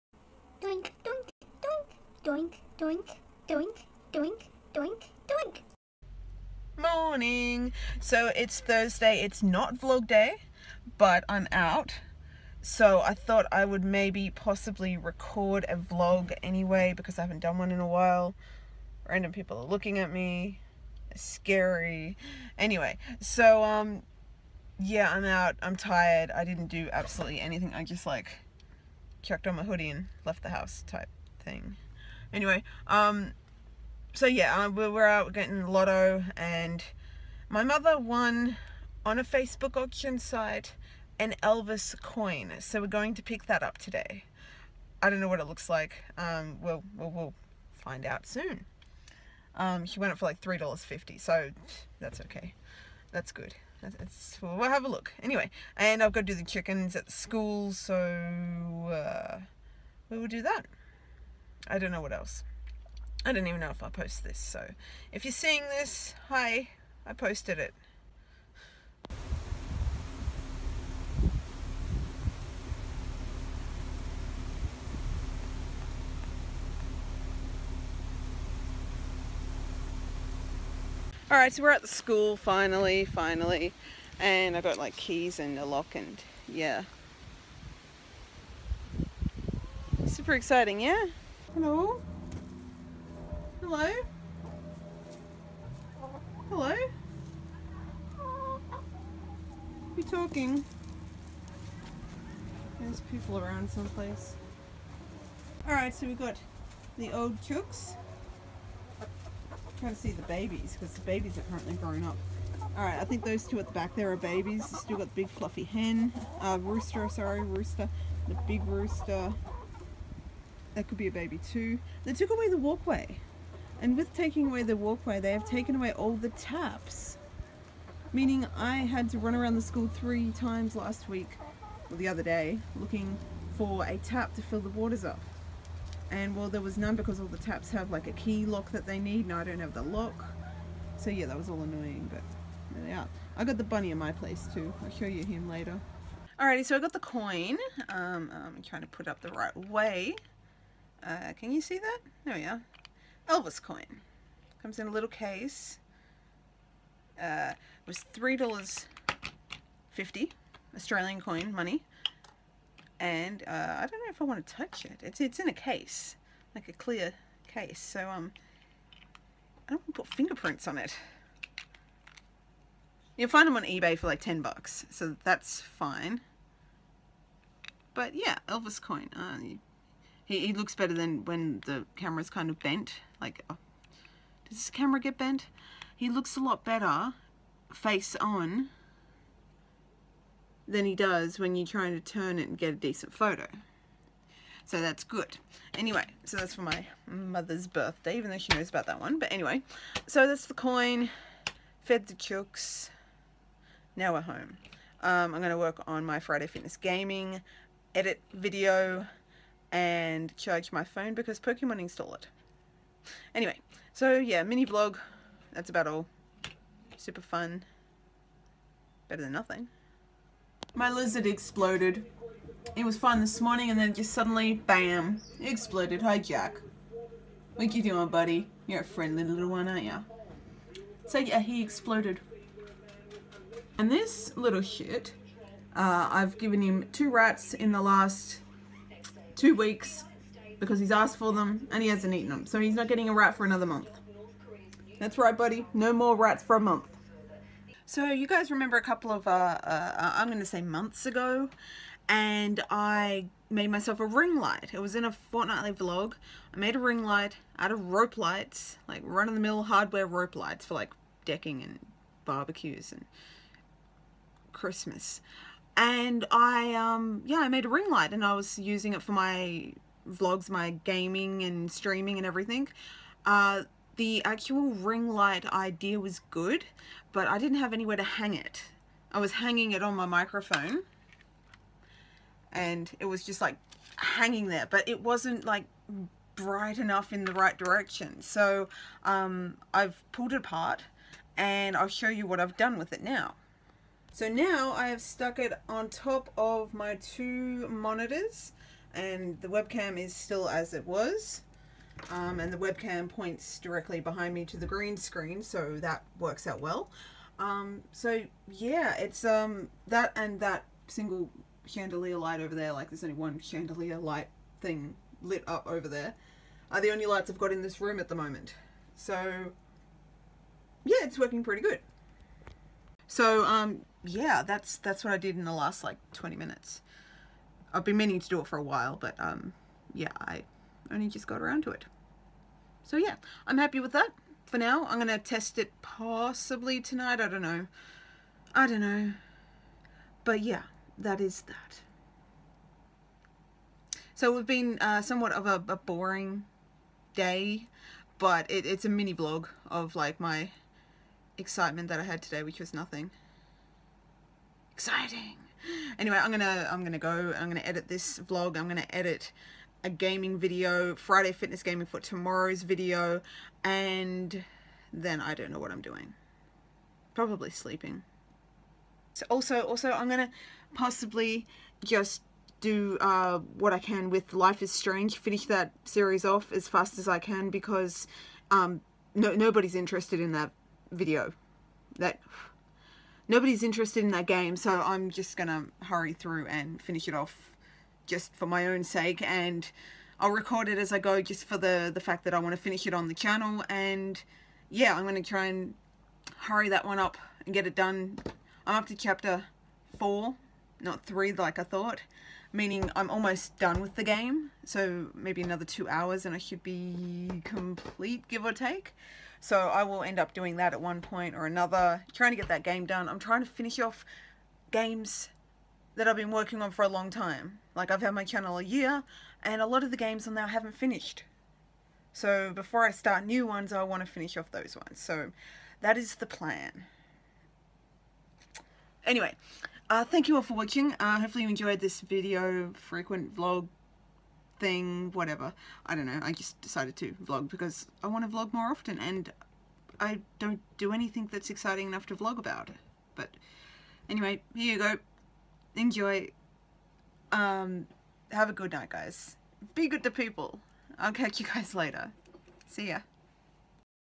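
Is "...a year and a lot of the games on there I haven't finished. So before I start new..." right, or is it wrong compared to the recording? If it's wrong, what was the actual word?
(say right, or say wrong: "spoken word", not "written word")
right.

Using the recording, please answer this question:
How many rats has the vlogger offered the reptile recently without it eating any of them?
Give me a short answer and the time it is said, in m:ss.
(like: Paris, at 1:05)
2, at 3:56.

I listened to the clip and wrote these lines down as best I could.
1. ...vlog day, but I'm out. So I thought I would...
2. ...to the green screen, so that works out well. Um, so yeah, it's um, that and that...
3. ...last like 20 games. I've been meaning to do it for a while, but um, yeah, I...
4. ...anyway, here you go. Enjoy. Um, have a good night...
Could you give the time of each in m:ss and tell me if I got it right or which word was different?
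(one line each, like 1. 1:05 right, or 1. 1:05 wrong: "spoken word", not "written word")
1. 0:09 right
2. 5:04 right
3. 5:25 wrong: "minutes", not "games"
4. 7:24 right.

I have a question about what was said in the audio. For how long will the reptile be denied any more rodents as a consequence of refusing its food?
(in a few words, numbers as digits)
a month.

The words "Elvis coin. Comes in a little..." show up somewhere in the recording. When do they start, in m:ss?
2:33.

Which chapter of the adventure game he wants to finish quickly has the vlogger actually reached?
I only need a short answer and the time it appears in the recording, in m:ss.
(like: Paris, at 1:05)
chapter 4, at 6:38.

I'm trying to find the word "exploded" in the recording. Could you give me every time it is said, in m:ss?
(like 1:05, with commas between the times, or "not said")
3:41, 3:45, 3:51.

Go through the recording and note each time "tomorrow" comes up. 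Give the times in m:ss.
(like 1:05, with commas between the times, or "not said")
6:01.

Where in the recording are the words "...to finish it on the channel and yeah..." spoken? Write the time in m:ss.
6:32.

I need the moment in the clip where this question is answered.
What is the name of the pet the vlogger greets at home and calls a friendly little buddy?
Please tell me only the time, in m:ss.
3:46.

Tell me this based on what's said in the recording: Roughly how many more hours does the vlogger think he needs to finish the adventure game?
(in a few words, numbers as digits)
2 hours.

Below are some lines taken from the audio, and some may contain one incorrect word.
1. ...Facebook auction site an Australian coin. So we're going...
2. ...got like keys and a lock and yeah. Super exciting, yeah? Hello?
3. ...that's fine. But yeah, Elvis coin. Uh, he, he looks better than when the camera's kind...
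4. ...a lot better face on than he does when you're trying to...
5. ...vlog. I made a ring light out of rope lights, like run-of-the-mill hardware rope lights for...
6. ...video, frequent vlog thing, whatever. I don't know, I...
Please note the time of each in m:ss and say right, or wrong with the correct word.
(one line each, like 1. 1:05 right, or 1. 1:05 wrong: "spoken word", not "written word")
1. 0:39 wrong: "Elvis", not "Australian"
2. 1:24 right
3. 2:55 right
4. 3:06 right
5. 4:15 right
6. 7:12 right.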